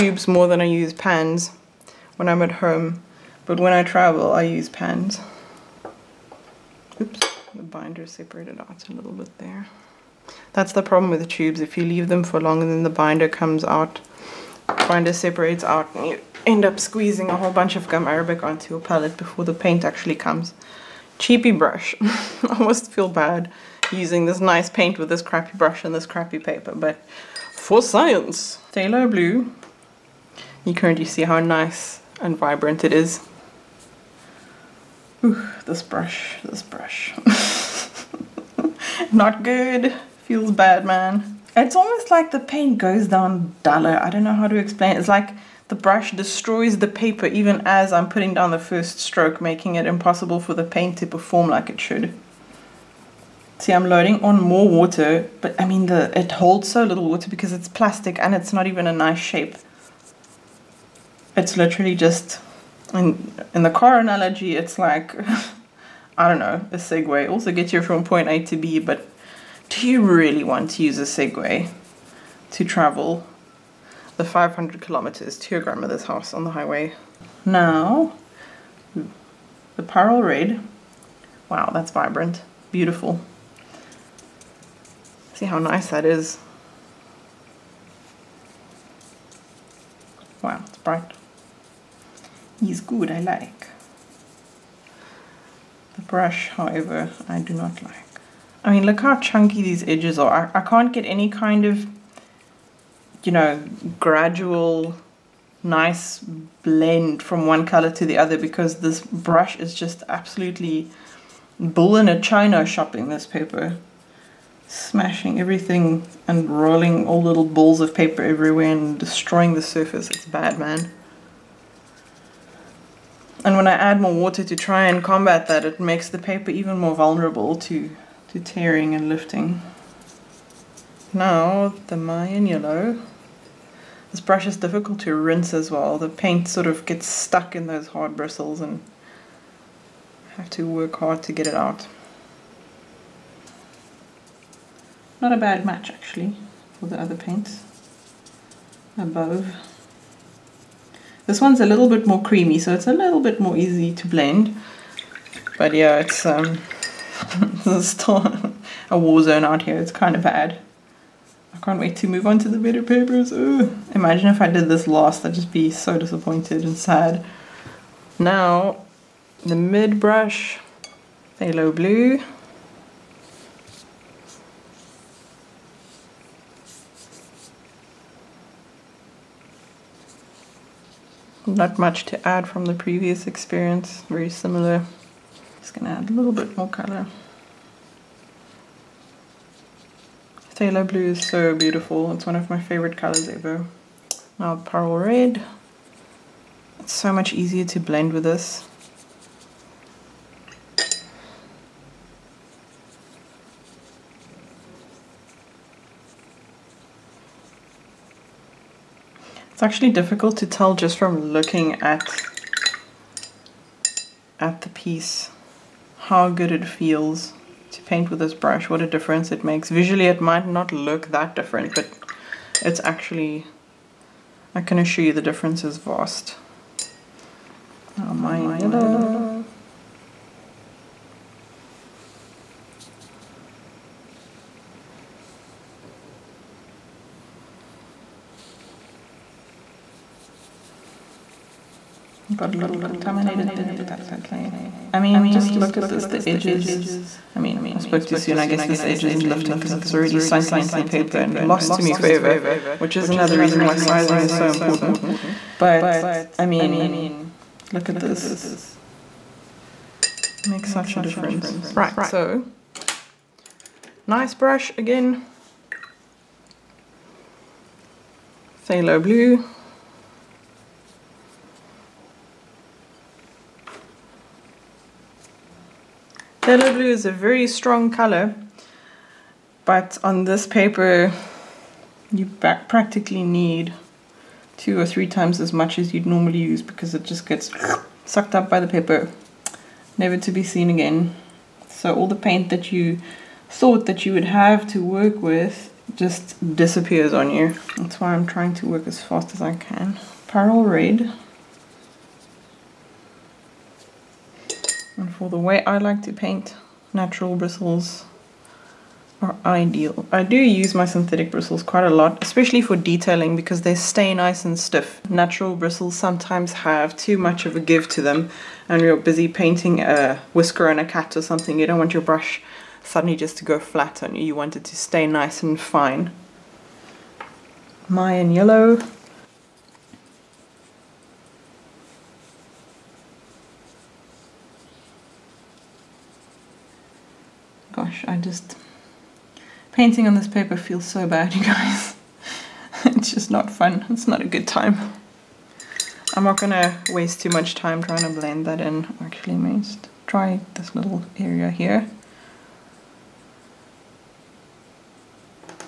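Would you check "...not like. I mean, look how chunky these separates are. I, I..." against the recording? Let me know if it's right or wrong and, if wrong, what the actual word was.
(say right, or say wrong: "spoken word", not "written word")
wrong: "edges", not "separates".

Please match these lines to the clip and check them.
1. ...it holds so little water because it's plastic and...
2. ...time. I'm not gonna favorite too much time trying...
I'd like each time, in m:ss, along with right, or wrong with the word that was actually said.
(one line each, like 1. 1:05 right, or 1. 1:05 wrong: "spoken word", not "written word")
1. 0:56 right
2. 5:44 wrong: "waste", not "favorite".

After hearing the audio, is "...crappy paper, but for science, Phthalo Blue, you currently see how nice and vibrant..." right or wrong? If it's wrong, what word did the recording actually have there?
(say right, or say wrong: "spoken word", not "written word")
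right.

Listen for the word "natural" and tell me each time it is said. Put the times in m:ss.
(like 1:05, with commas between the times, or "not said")
5:06, 5:15.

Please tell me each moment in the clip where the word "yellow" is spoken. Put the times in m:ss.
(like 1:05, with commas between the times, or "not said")
2:12, 3:48, 5:28.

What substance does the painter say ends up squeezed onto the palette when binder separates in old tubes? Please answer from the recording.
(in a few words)
gum arabic.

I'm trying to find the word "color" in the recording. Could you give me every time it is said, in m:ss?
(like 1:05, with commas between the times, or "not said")
1:47, 3:06, 3:12, 4:37.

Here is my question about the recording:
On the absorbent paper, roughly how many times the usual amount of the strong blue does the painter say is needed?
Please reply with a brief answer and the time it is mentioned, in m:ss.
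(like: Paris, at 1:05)
two or three times, at 4:44.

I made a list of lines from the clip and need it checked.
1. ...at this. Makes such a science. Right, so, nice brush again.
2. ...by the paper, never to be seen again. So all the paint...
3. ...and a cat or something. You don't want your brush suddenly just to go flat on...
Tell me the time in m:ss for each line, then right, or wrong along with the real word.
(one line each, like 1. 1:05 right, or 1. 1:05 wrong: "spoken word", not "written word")
1. 4:17 wrong: "difference", not "science"
2. 4:48 right
3. 5:20 right.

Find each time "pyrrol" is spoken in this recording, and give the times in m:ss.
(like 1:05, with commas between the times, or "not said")
1:19, 3:14, 5:00.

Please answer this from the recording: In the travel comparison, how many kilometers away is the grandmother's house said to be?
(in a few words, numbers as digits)
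500.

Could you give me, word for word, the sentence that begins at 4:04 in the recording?
I mean, just look at this, the edges.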